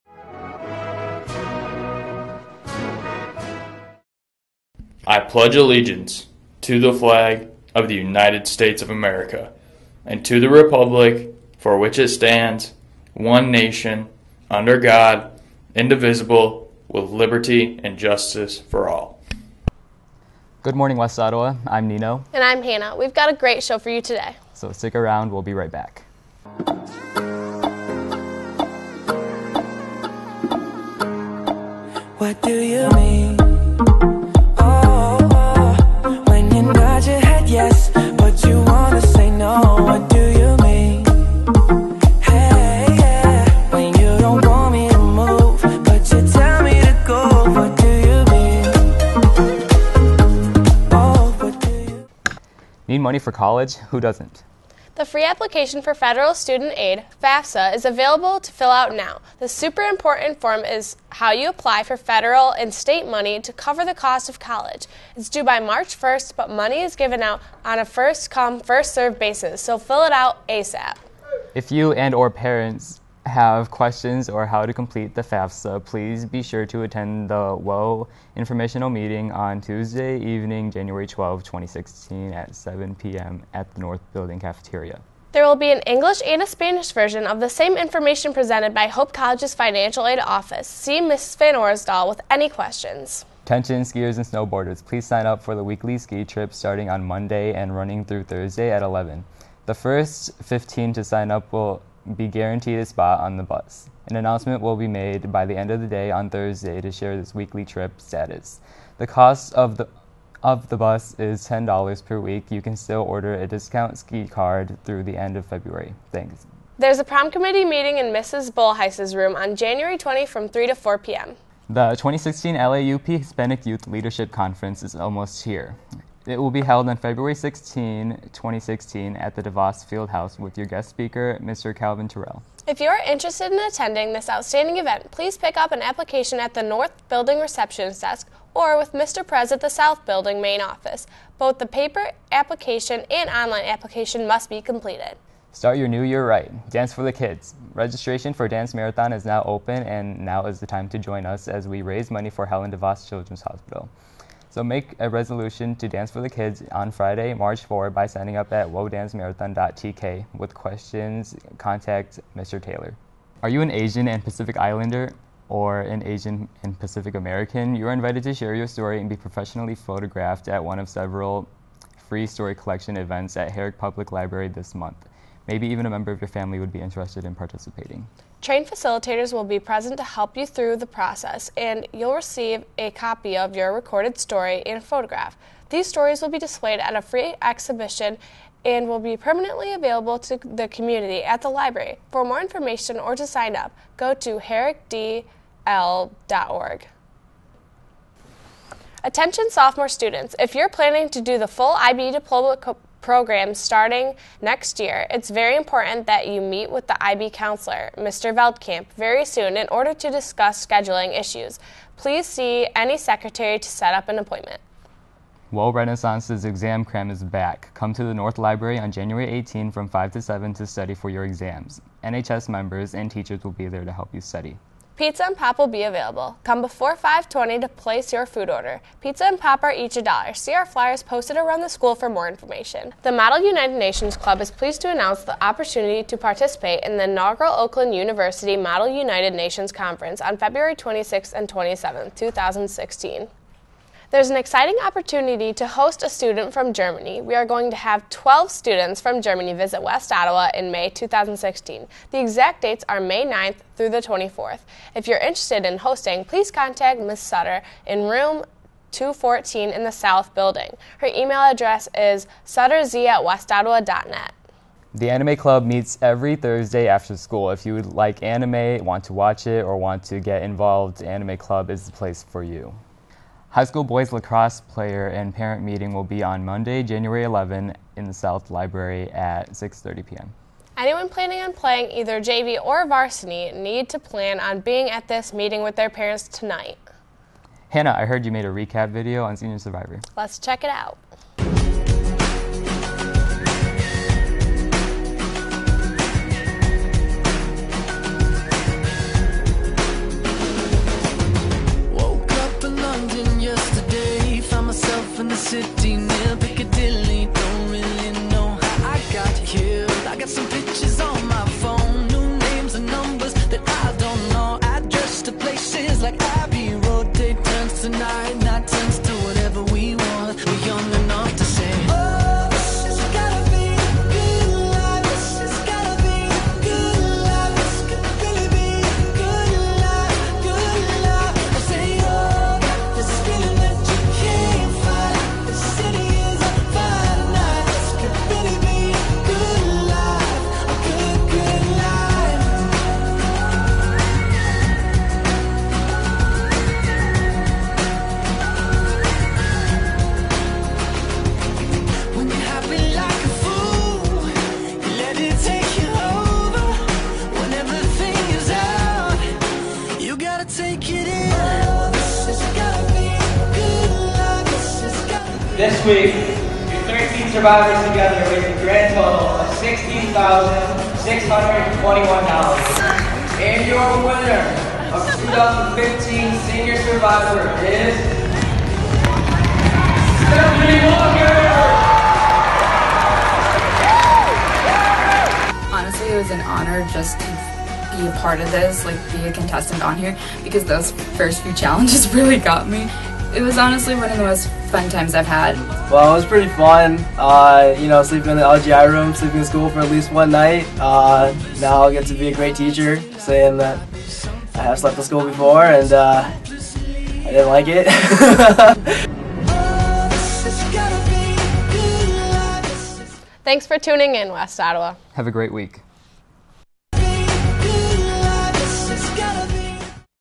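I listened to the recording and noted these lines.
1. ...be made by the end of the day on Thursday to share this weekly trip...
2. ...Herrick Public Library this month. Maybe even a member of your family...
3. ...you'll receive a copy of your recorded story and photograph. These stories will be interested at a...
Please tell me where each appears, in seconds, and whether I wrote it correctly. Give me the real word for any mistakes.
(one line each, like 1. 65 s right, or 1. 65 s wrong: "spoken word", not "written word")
1. 104 s right
2. 173 s right
3. 181 s wrong: "displayed", not "interested".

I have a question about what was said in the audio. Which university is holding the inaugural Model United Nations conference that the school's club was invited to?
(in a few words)
Oakland University.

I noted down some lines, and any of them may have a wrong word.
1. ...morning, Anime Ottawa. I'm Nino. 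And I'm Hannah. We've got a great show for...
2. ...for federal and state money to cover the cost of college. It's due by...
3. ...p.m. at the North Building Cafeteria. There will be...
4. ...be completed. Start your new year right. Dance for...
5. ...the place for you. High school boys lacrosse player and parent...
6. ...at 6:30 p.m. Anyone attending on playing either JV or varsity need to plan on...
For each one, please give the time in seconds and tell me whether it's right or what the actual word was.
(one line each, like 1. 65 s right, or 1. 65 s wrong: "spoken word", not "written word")
1. 20 s wrong: "West", not "Anime"
2. 61 s right
3. 82 s right
4. 144 s right
5. 271 s right
6. 279 s wrong: "planning", not "attending".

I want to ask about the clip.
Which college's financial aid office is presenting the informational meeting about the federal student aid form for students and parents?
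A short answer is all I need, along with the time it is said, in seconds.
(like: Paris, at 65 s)
Hope College, at 88 s.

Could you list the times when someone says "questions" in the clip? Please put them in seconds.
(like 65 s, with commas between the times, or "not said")
73 s, 92 s, 160 s.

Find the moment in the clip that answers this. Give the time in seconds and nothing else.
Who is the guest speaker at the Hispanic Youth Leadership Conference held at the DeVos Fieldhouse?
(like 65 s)
131 s.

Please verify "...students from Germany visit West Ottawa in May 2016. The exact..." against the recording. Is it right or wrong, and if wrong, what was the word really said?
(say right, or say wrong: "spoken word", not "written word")
right.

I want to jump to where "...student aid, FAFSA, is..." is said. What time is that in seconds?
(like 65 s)
56 s.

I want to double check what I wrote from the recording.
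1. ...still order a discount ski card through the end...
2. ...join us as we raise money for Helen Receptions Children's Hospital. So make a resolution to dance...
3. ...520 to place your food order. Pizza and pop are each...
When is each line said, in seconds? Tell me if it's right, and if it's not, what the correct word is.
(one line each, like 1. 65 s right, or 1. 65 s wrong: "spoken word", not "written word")
1. 112 s right
2. 150 s wrong: "DeVos", not "Receptions"
3. 226 s right.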